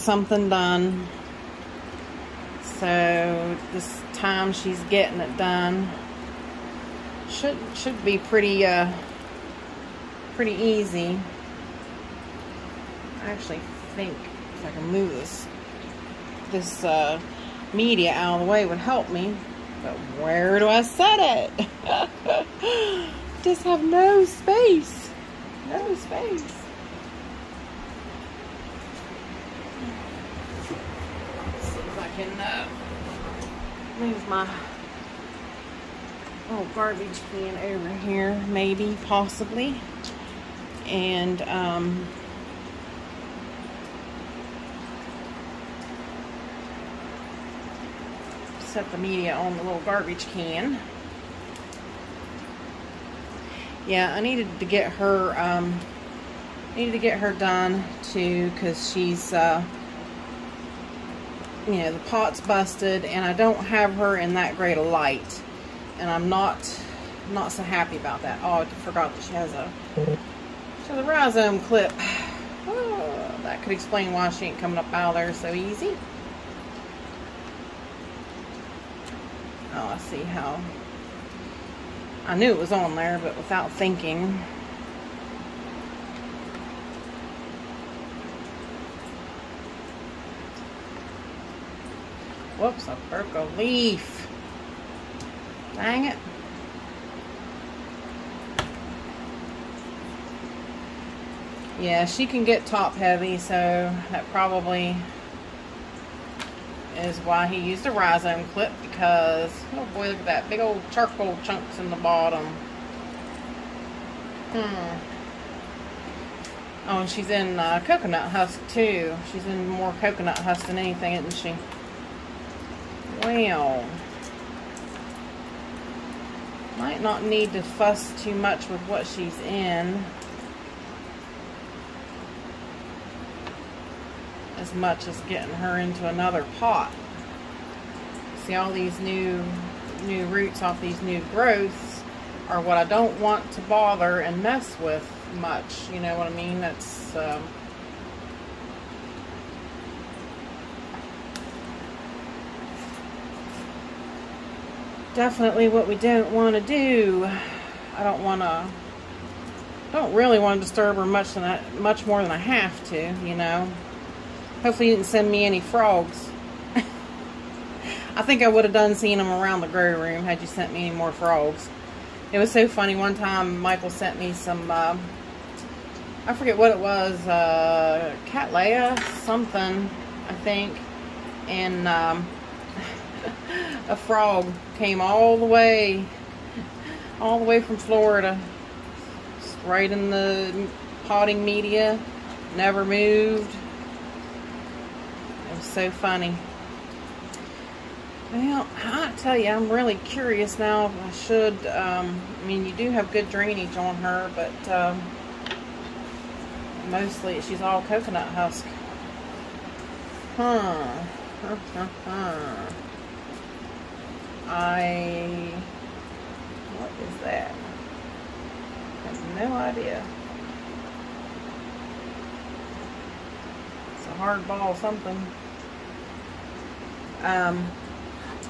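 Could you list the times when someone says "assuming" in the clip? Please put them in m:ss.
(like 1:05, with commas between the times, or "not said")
not said.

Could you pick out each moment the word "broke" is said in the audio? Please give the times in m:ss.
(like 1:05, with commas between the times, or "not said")
1:33.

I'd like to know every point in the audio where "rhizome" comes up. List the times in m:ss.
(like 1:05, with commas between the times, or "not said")
1:11, 1:47.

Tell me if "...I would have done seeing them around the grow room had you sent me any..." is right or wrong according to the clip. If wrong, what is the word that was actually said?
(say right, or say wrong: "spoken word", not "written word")
right.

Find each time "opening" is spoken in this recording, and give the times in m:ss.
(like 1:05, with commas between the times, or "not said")
not said.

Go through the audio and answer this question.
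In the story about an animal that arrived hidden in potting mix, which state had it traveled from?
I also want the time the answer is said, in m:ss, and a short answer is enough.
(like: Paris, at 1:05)
Florida, at 3:07.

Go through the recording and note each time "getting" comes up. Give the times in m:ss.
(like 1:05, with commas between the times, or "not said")
0:04, 2:15.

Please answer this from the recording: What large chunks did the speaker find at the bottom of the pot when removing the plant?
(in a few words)
charcoal.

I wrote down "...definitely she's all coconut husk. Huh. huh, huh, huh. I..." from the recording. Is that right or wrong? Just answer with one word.
wrong.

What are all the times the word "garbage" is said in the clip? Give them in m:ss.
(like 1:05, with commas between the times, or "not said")
0:36, 0:49.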